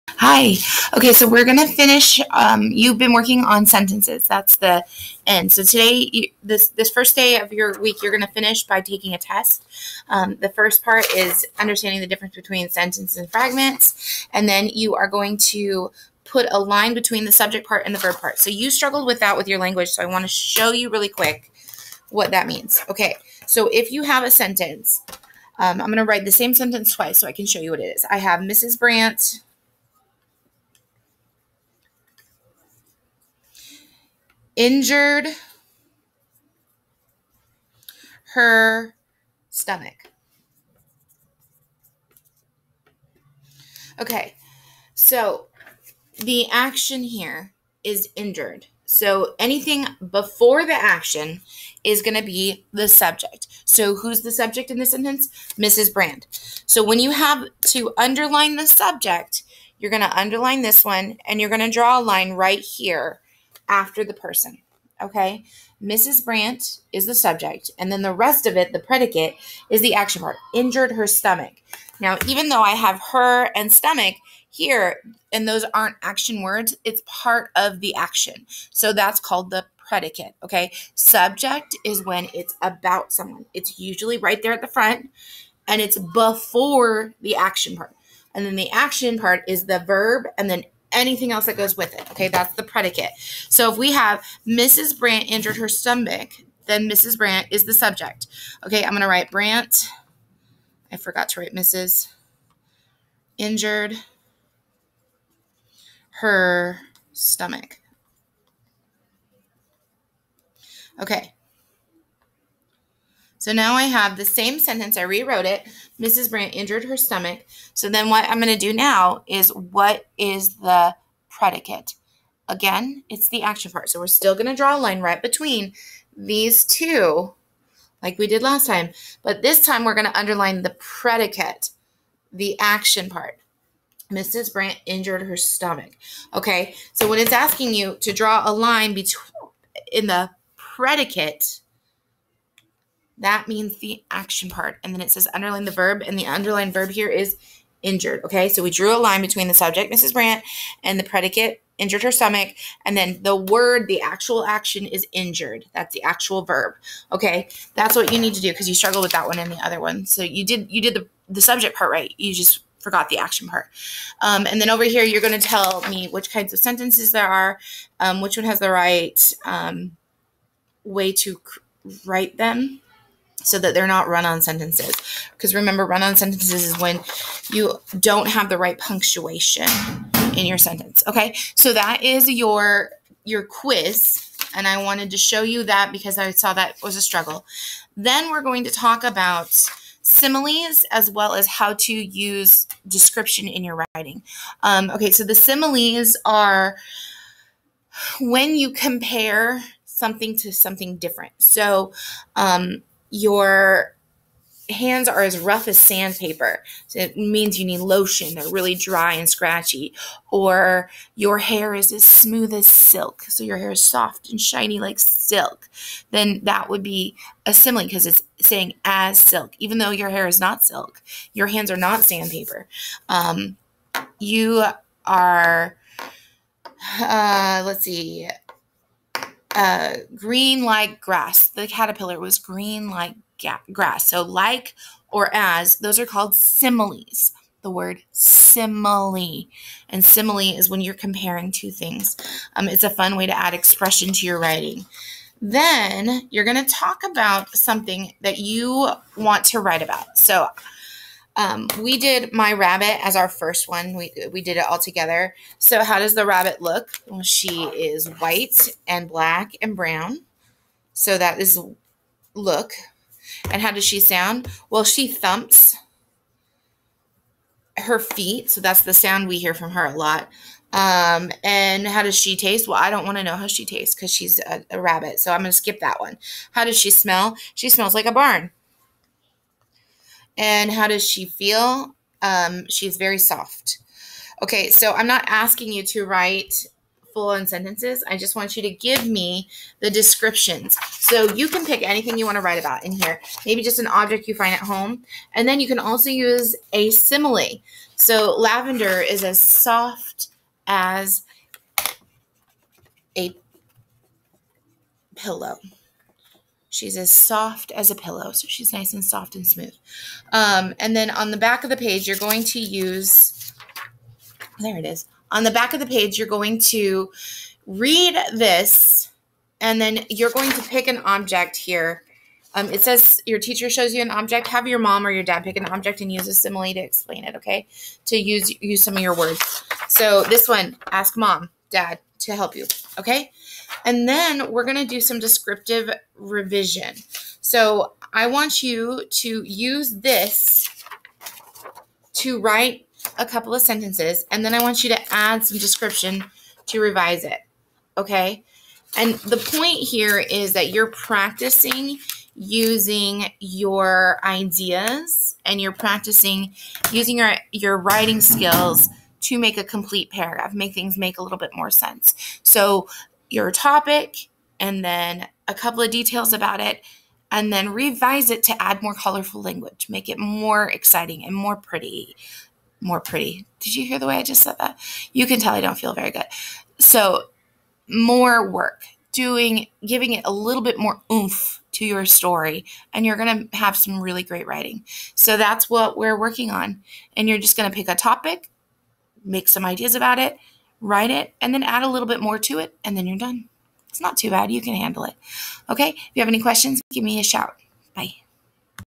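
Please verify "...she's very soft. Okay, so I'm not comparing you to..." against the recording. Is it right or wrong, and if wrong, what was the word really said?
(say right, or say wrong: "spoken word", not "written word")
wrong: "asking", not "comparing".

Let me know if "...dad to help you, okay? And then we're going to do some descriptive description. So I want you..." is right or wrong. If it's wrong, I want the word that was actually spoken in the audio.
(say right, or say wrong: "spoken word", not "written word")
wrong: "revision", not "description".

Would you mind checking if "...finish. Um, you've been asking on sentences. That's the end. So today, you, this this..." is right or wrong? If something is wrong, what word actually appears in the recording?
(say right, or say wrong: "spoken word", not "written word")
wrong: "working", not "asking".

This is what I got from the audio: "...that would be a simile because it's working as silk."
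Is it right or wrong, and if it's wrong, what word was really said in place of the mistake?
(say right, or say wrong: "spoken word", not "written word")
wrong: "saying", not "working".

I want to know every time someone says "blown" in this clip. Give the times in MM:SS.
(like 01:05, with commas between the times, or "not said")
not said.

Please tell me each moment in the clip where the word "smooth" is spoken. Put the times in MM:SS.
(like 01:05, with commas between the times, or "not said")
03:32, 05:09.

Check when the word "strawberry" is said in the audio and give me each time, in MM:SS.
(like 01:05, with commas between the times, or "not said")
not said.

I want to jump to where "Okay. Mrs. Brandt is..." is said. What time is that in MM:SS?
01:05.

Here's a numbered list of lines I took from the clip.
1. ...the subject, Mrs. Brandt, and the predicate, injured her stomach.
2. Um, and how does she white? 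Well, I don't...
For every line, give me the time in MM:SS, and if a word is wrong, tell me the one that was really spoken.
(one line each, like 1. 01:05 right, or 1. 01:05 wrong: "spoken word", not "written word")
1. 02:29 right
2. 04:30 wrong: "taste", not "white".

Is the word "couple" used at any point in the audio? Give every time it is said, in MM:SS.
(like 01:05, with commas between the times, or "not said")
05:43, 06:05.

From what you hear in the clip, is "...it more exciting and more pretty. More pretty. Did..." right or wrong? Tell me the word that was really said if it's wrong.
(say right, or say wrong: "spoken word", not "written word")
right.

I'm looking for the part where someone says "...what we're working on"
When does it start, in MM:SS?
06:25.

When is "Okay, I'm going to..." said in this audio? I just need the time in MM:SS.
01:38.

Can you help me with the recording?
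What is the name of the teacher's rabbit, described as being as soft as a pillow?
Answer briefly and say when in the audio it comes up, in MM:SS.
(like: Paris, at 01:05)
Lavender, at 04:58.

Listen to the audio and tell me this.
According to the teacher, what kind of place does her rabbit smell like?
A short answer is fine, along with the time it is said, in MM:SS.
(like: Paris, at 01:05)
a barn, at 04:38.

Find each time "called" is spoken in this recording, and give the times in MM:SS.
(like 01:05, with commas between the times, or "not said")
01:19, 03:56.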